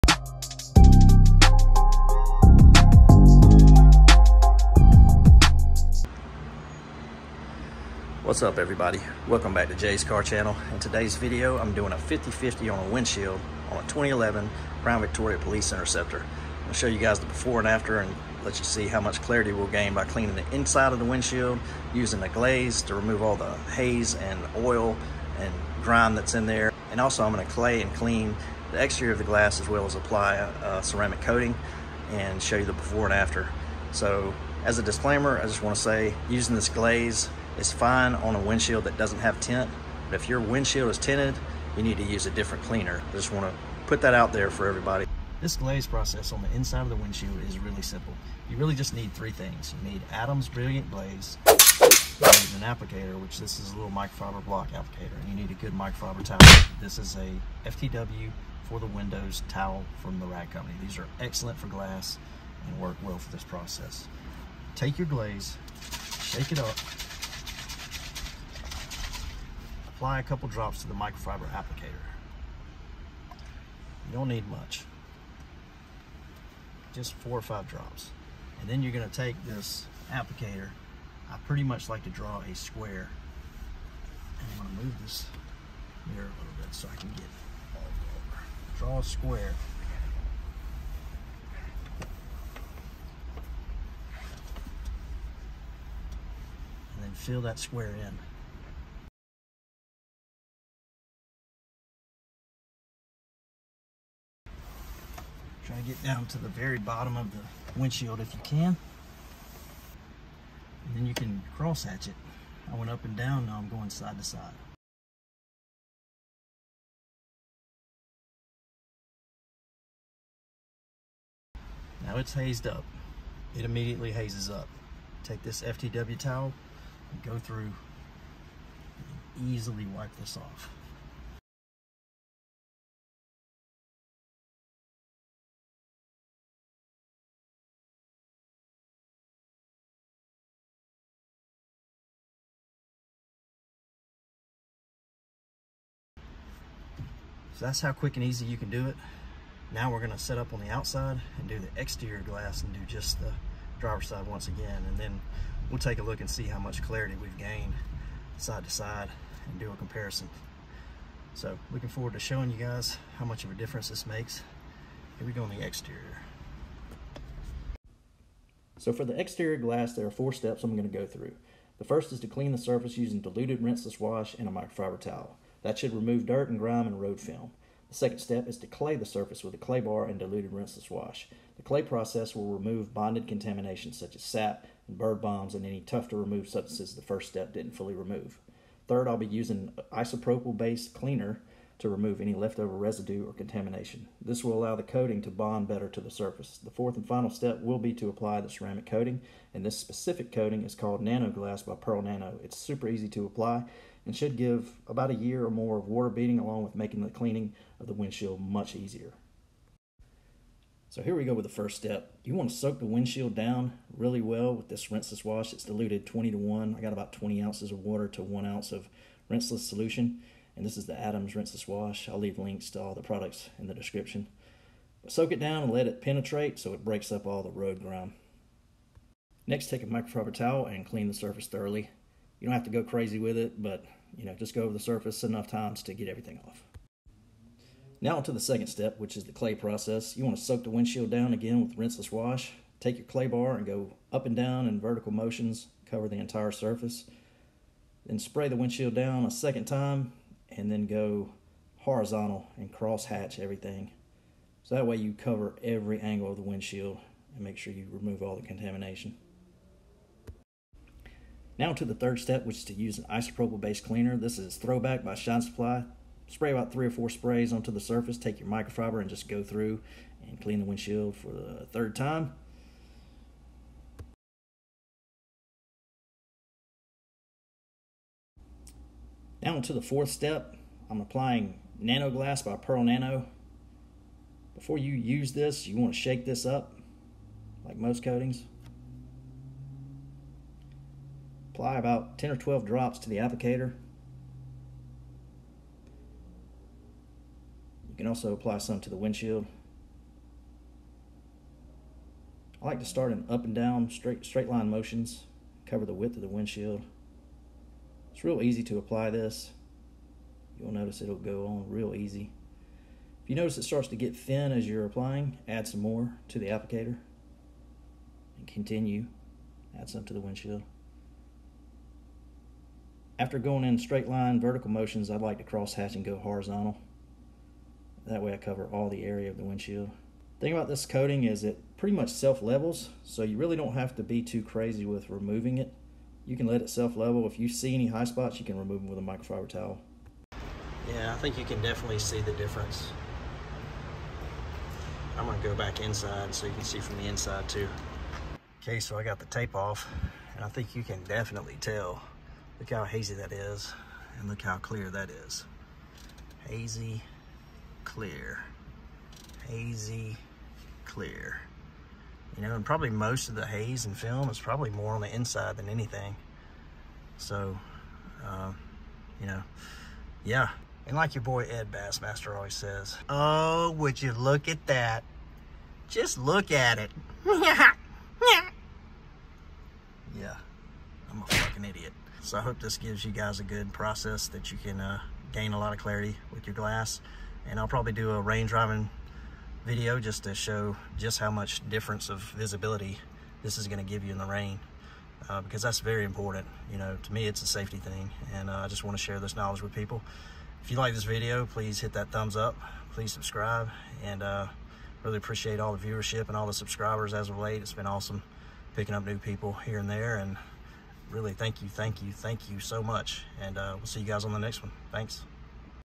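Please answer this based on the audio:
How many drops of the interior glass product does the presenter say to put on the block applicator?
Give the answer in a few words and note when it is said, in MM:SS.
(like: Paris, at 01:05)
4 or 5, at 01:17.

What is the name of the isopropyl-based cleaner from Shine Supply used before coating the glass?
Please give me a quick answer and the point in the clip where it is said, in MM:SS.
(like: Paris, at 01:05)
Throwback, at 04:24.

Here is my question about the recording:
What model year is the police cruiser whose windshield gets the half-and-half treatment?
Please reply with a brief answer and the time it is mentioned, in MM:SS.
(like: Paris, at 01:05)
2011, at 00:13.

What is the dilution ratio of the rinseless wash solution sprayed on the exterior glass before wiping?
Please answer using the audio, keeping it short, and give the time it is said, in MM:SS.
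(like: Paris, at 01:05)
20 to 1, at 03:36.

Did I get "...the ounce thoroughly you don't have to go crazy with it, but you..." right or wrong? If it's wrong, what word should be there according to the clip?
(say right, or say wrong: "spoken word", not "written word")
wrong: "surface", not "ounce".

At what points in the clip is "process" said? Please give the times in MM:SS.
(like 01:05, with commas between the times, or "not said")
00:45, 01:03, 03:01, 03:59, 06:23.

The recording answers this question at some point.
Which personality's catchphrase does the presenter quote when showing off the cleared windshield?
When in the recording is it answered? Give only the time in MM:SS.
06:11.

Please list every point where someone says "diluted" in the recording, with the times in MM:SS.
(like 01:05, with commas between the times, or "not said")
02:53, 03:00, 03:35.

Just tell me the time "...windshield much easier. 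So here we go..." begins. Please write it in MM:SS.
03:27.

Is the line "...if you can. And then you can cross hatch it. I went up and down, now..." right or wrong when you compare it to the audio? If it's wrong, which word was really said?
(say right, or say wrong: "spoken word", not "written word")
right.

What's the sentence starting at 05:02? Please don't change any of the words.
I like to start in up and down straight straight line motions, cover the width of the windshield.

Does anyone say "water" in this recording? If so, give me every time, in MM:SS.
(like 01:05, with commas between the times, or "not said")
03:25, 03:37.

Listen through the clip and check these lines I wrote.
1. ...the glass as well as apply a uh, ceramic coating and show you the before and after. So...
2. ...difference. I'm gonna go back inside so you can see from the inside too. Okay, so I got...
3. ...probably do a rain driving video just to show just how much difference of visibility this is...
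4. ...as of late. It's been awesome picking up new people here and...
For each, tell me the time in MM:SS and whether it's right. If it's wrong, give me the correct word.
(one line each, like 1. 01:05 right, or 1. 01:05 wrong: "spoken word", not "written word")
1. 00:29 right
2. 05:42 right
3. 06:27 right
4. 06:47 right.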